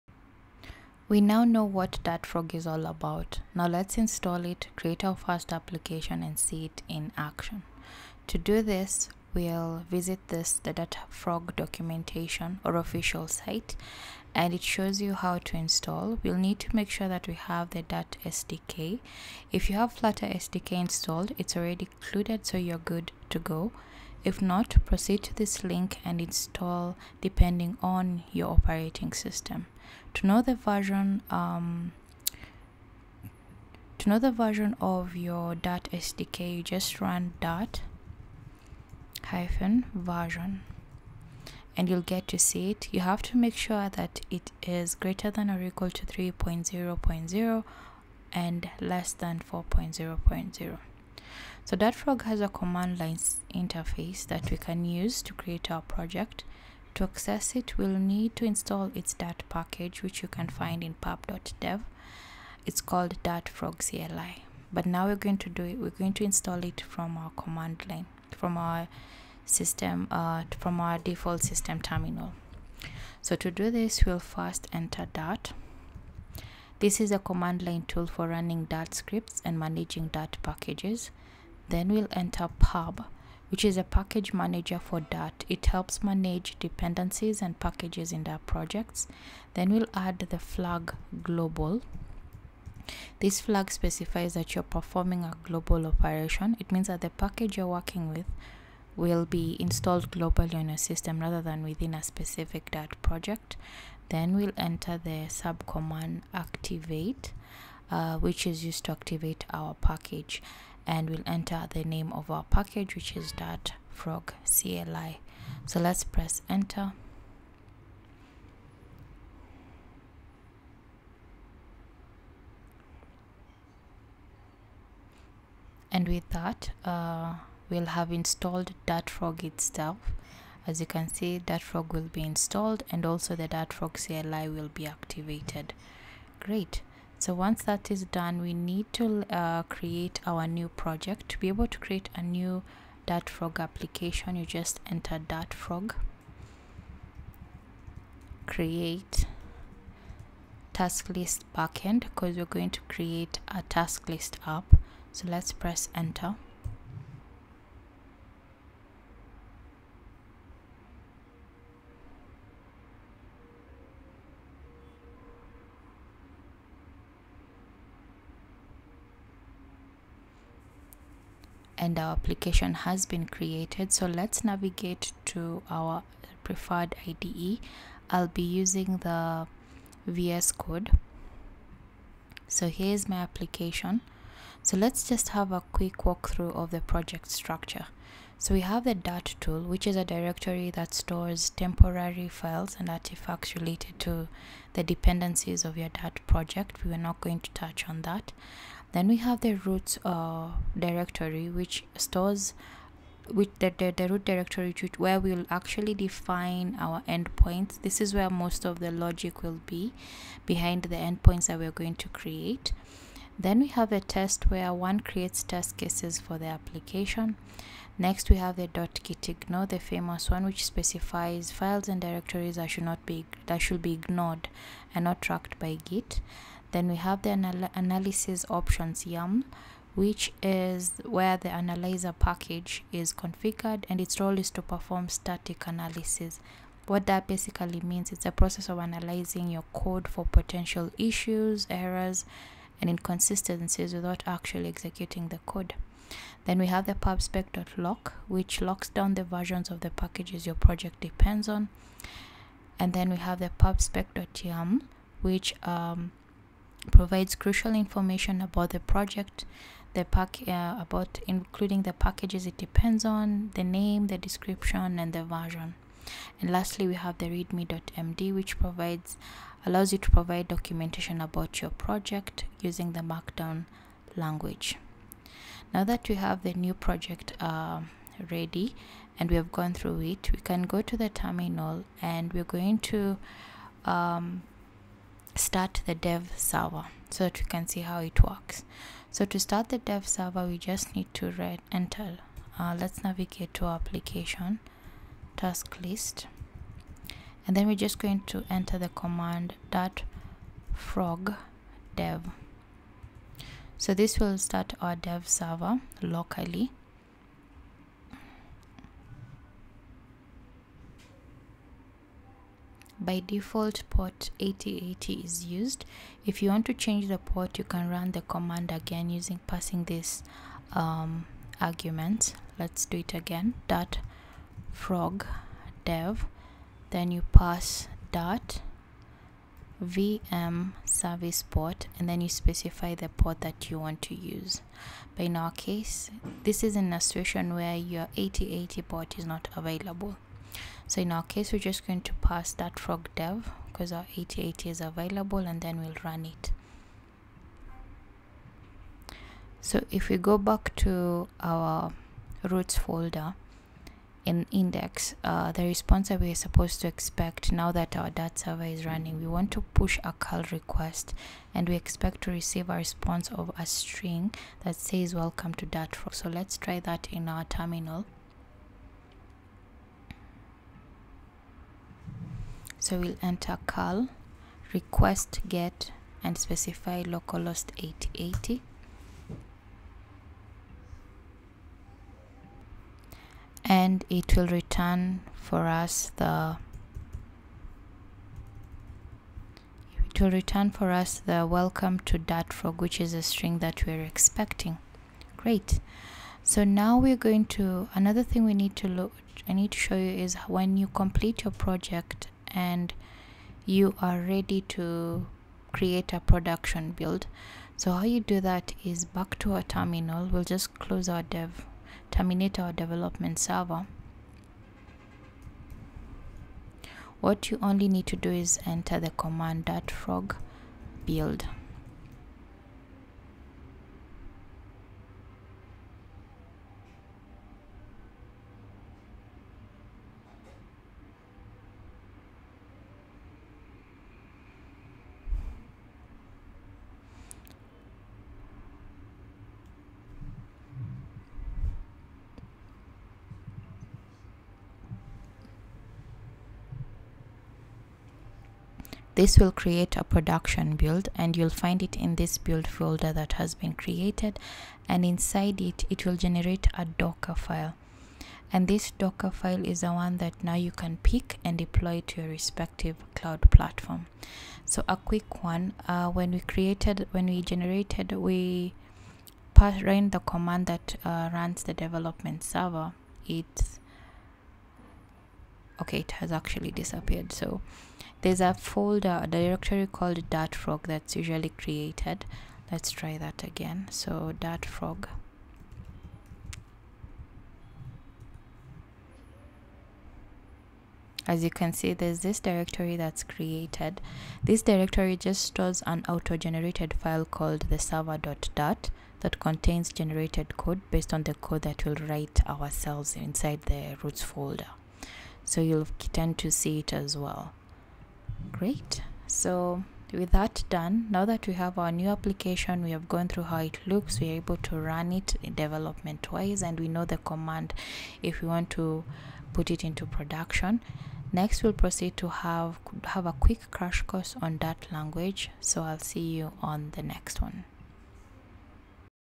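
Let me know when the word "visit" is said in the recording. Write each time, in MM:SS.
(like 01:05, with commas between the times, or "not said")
00:09.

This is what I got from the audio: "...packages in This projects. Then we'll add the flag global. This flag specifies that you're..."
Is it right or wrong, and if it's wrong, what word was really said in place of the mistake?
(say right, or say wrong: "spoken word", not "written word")
wrong: "Dart", not "This".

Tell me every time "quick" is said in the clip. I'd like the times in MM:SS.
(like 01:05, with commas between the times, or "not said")
03:05, 07:44, 08:43.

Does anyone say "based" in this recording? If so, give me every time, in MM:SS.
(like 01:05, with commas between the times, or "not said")
08:20.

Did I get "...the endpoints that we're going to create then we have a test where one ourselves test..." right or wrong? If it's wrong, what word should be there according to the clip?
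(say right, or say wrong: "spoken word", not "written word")
wrong: "creates", not "ourselves".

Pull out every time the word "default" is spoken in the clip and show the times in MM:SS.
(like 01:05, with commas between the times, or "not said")
01:10, 05:13.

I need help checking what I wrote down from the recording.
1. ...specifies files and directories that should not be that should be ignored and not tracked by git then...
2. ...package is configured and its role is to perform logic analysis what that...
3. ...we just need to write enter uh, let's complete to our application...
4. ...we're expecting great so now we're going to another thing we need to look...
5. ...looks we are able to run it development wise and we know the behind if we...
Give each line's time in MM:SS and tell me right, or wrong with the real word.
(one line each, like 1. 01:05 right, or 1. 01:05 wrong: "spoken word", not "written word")
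1. 03:40 right
2. 03:52 wrong: "static", not "logic"
3. 04:50 wrong: "navigate", not "complete"
4. 06:33 right
5. 08:33 wrong: "command", not "behind".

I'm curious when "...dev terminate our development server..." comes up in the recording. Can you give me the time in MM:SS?
06:51.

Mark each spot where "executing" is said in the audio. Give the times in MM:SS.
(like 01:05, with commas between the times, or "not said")
04:04.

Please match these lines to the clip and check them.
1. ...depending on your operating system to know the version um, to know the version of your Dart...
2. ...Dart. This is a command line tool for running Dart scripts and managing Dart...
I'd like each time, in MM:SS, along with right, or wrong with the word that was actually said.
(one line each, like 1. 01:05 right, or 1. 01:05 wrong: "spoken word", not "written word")
1. 00:27 right
2. 01:15 right.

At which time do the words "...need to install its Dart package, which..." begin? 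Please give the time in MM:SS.
00:57.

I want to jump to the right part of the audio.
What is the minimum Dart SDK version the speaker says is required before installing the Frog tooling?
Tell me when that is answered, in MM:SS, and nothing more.
00:46.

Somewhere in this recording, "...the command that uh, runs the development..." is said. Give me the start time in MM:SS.
07:50.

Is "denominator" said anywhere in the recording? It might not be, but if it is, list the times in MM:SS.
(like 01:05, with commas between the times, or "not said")
not said.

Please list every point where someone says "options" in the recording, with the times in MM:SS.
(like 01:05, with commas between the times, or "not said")
03:48.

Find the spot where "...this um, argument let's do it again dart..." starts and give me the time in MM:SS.
05:19.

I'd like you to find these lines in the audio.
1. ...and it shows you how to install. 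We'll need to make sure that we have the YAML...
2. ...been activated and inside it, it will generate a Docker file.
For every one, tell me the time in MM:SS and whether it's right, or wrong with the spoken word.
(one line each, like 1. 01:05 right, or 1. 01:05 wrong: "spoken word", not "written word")
1. 00:14 wrong: "Dart", not "YAML"
2. 07:33 wrong: "created", not "activated".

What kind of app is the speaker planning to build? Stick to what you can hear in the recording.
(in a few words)
task list app.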